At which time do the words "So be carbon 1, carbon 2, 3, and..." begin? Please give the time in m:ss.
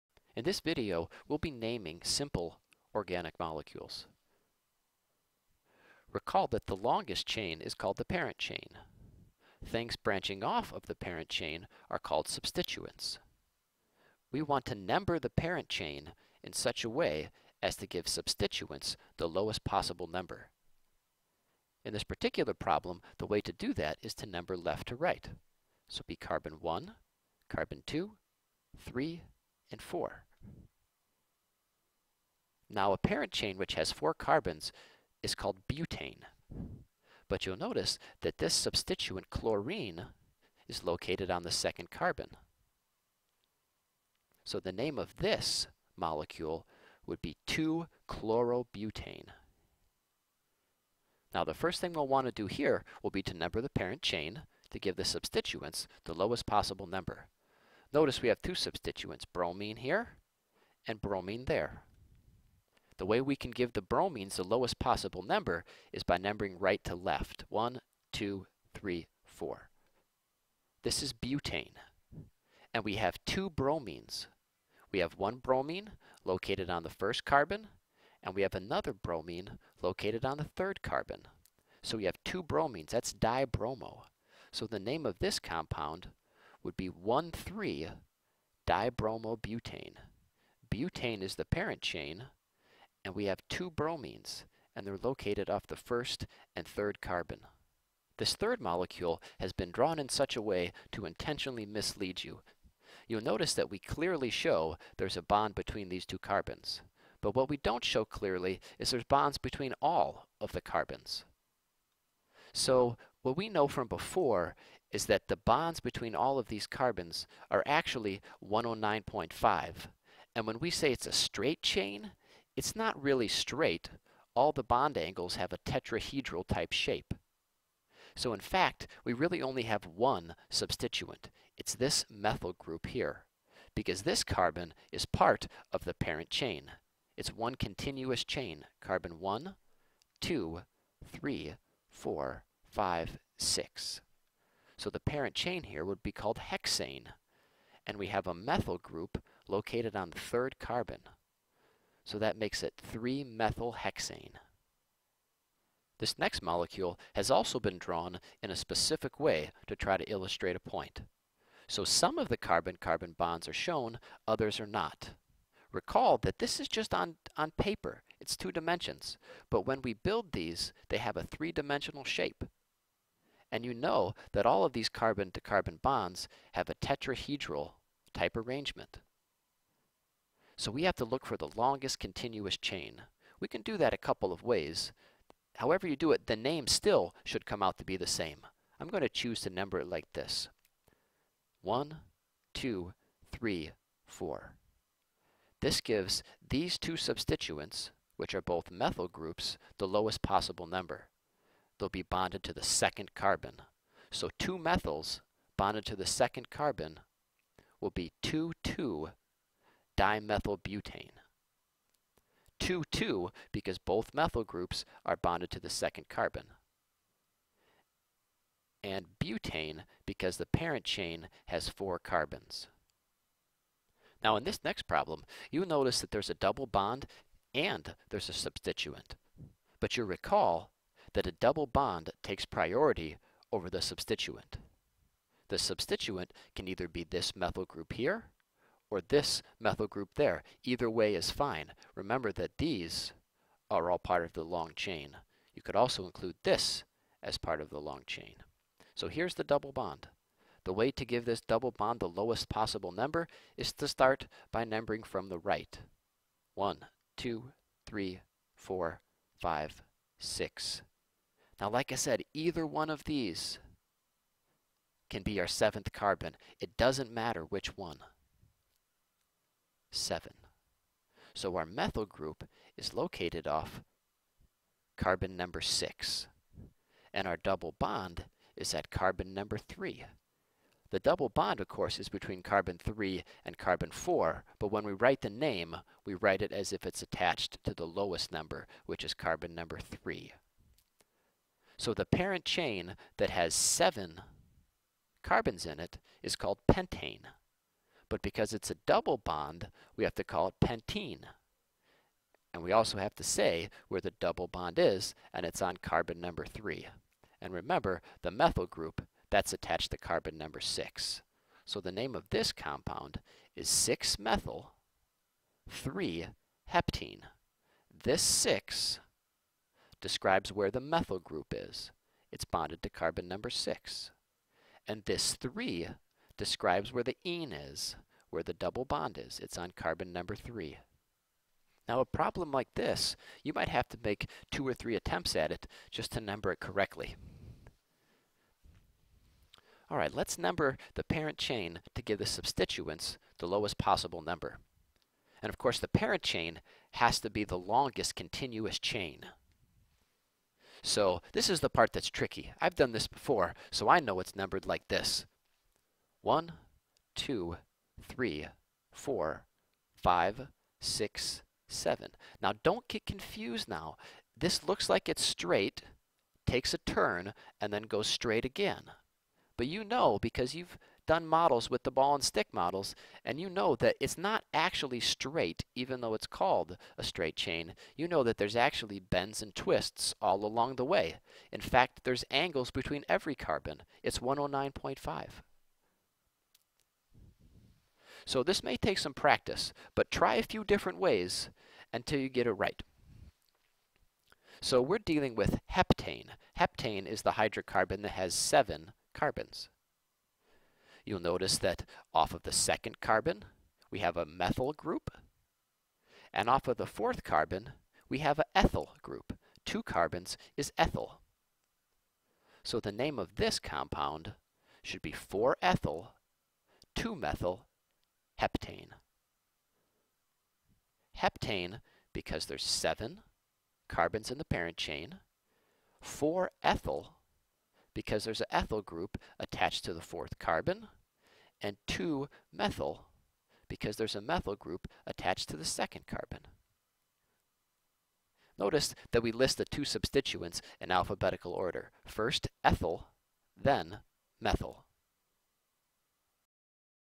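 0:25.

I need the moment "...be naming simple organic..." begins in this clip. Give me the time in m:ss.
0:01.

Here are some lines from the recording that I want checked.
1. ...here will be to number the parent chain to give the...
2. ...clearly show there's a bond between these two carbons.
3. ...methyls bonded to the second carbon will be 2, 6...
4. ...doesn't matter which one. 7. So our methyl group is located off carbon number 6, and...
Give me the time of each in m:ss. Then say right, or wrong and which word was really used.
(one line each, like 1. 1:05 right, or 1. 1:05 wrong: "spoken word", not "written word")
1. 0:52 right
2. 1:43 right
3. 3:24 wrong: "2", not "6"
4. 4:26 right.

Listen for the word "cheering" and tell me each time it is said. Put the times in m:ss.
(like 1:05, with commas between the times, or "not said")
not said.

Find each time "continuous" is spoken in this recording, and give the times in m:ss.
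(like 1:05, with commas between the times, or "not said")
2:17, 3:01, 5:48.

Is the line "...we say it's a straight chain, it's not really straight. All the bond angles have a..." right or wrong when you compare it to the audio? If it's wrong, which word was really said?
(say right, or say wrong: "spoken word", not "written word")
right.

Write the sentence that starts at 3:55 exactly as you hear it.
The substituent can either be this methyl group here or this methyl group there.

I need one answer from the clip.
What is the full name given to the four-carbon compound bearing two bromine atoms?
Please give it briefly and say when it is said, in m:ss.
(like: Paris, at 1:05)
1,3-dibromobutane, at 1:26.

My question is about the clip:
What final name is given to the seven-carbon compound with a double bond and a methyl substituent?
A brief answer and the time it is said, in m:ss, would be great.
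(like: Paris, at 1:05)
6-methyl-3-heptene, at 5:13.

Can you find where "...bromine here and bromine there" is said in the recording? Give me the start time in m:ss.
0:59.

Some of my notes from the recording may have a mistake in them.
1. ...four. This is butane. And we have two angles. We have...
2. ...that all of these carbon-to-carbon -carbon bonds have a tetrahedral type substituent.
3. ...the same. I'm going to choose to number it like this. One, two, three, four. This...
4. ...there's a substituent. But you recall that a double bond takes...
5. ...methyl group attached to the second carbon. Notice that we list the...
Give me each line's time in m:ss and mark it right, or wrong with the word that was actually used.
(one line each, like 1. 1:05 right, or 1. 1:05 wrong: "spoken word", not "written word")
1. 1:09 wrong: "bromines", not "angles"
2. 2:54 wrong: "arrangement", not "substituent"
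3. 3:07 right
4. 3:48 right
5. 7:14 right.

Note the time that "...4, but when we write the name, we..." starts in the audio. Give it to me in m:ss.
4:43.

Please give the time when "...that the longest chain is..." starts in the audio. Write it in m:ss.
0:06.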